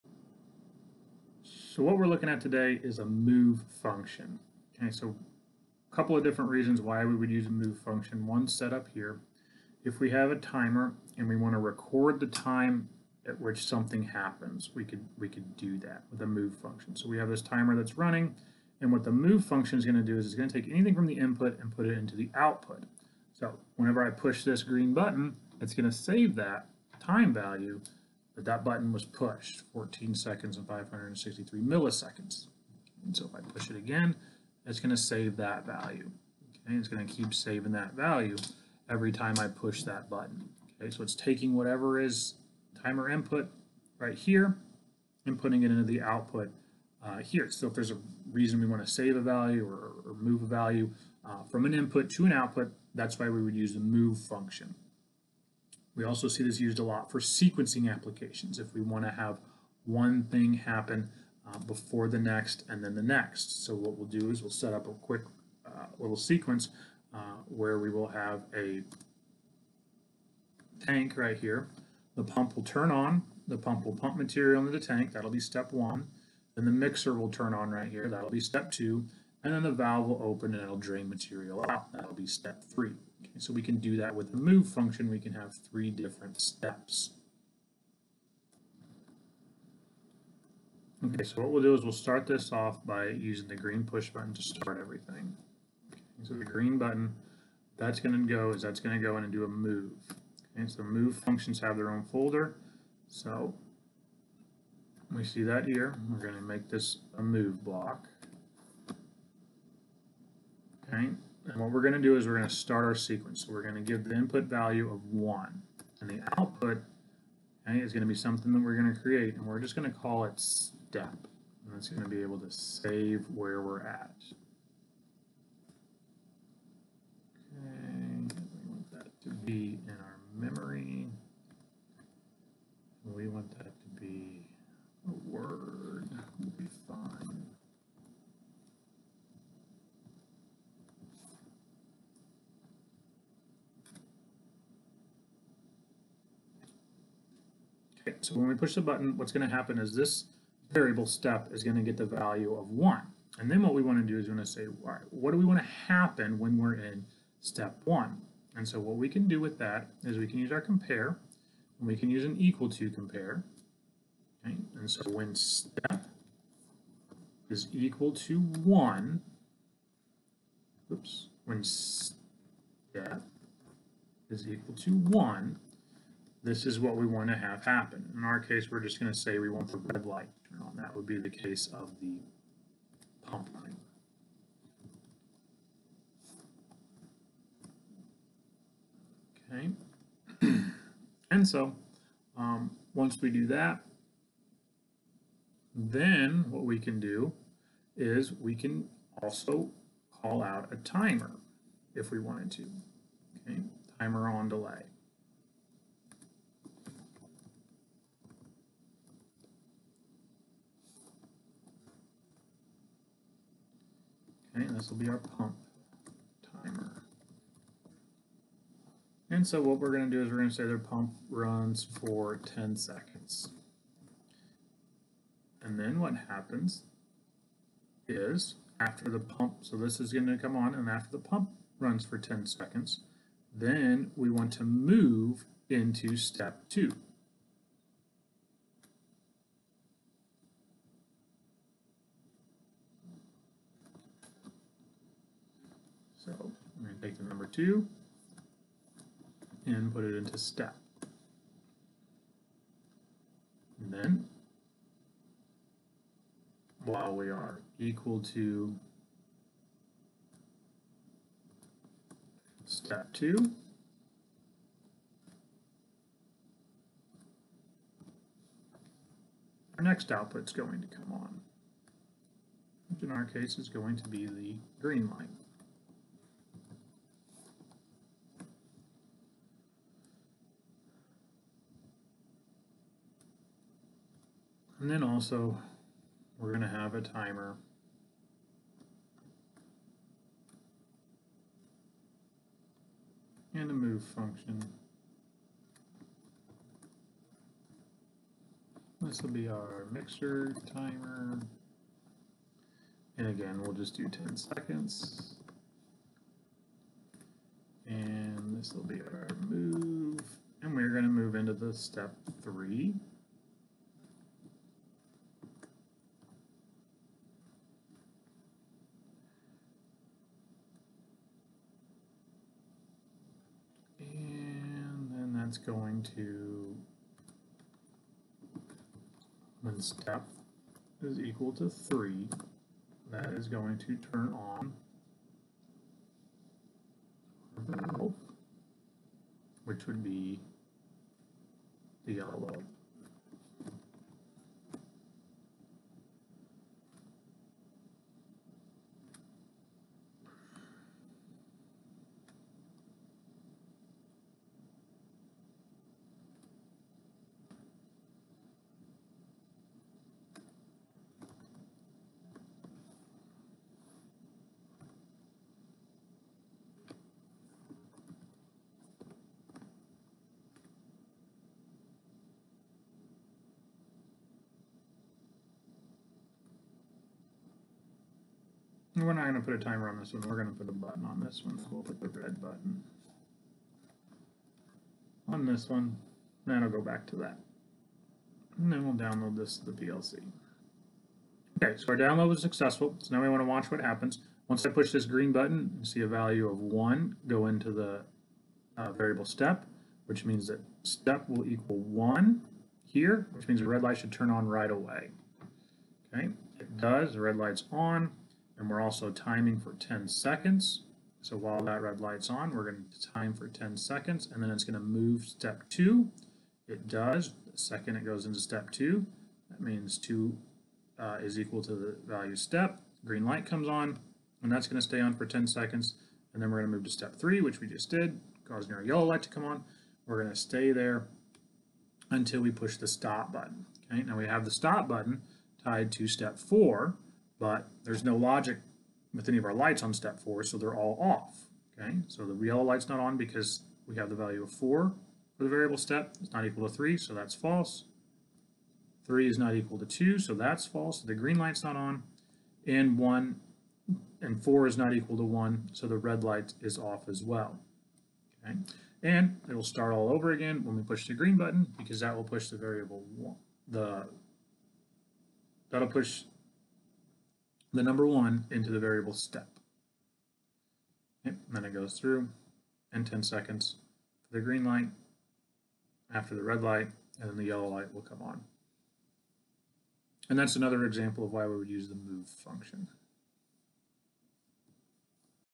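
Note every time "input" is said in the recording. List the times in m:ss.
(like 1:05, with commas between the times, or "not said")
0:21, 0:43, 0:51, 1:54.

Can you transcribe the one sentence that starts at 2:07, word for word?
Okay, we want that to be in our memory.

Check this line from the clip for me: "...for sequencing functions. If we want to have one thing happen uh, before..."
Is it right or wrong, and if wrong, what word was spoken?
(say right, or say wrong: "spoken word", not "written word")
wrong: "applications", not "functions".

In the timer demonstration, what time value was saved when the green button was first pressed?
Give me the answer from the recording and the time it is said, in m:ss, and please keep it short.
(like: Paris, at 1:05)
14 seconds and 563 milliseconds, at 0:29.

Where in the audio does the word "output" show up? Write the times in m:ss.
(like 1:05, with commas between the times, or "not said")
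0:22, 0:46, 0:52, 1:56, 4:30.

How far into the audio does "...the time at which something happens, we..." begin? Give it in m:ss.
0:12.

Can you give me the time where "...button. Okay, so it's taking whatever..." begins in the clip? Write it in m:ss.
0:40.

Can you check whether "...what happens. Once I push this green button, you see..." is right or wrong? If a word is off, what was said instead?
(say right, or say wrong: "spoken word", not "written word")
right.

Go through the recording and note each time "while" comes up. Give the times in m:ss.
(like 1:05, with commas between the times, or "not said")
4:16, 6:51.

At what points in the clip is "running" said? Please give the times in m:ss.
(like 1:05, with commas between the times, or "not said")
0:17, 3:03.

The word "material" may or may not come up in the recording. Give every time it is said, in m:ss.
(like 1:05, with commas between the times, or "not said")
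1:14, 1:21.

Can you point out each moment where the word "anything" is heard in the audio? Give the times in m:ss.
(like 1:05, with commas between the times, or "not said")
0:20.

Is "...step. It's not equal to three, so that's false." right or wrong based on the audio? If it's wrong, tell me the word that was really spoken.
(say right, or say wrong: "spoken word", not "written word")
right.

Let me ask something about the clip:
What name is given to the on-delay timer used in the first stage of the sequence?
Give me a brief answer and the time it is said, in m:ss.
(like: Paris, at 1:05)
pump timer, at 3:35.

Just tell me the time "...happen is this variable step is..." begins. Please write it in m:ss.
2:29.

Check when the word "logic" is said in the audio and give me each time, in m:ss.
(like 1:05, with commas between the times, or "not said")
7:18.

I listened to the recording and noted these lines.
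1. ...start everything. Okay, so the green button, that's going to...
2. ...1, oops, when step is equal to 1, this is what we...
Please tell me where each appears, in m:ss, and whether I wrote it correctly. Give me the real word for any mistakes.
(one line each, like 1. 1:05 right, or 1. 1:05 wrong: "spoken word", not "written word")
1. 1:34 right
2. 2:48 right.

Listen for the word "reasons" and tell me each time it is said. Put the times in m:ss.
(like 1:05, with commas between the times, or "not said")
0:06, 0:48.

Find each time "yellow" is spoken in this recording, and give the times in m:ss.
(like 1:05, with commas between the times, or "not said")
5:42, 7:08, 7:22, 7:57.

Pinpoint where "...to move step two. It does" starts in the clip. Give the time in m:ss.
6:54.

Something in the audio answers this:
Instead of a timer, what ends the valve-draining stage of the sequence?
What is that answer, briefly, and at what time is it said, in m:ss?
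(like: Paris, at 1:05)
red button, at 6:22.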